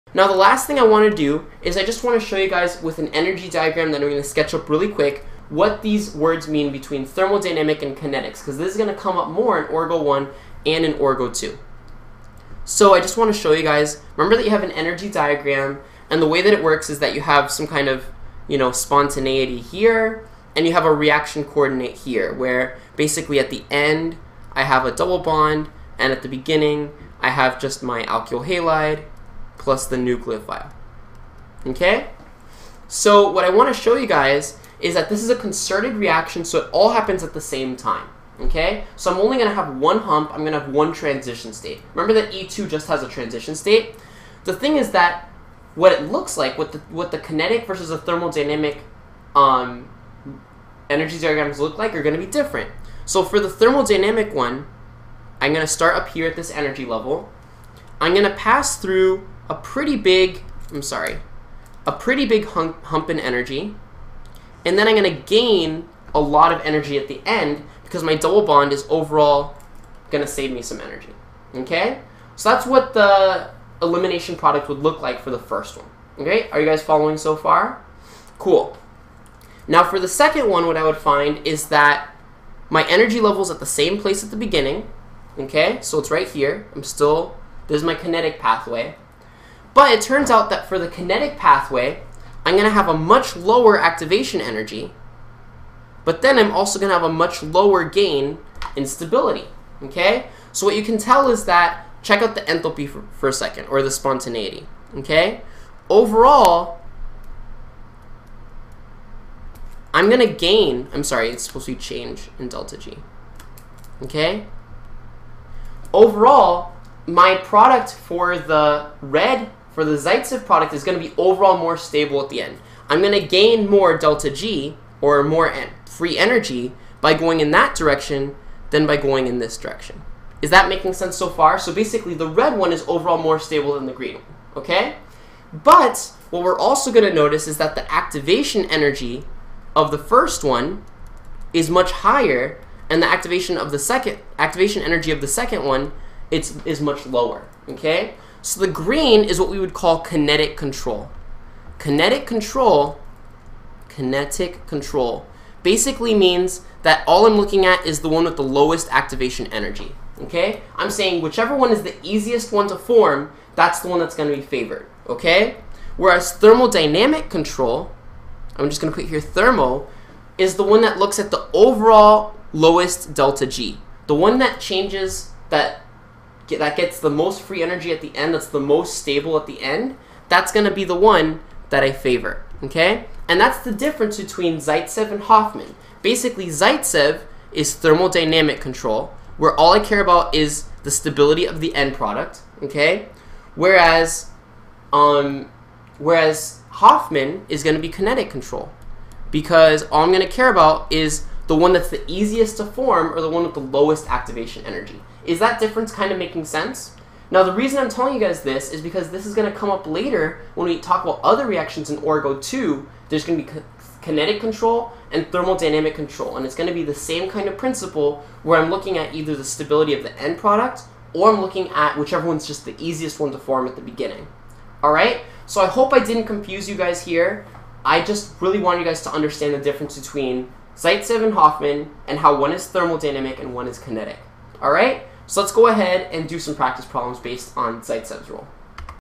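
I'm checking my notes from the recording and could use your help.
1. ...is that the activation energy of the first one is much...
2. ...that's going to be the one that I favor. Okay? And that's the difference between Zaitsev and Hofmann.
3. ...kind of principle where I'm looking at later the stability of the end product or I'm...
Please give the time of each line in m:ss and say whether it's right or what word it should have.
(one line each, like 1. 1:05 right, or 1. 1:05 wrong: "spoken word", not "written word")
1. 2:17 right
2. 3:00 right
3. 3:37 wrong: "either", not "later".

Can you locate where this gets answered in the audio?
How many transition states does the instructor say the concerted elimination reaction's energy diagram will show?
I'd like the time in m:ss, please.
0:40.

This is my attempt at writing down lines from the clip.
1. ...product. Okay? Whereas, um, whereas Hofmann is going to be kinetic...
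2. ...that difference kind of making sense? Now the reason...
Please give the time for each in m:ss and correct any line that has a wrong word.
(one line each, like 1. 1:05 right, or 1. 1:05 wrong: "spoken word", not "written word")
1. 3:11 right
2. 3:25 right.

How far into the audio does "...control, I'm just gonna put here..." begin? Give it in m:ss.
2:47.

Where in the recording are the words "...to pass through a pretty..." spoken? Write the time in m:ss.
0:58.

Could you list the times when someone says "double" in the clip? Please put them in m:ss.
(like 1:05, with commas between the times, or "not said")
0:24, 1:08.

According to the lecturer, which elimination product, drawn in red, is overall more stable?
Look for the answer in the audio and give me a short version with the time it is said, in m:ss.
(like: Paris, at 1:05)
Zaitsev product, at 1:59.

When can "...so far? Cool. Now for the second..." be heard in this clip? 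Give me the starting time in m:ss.
1:17.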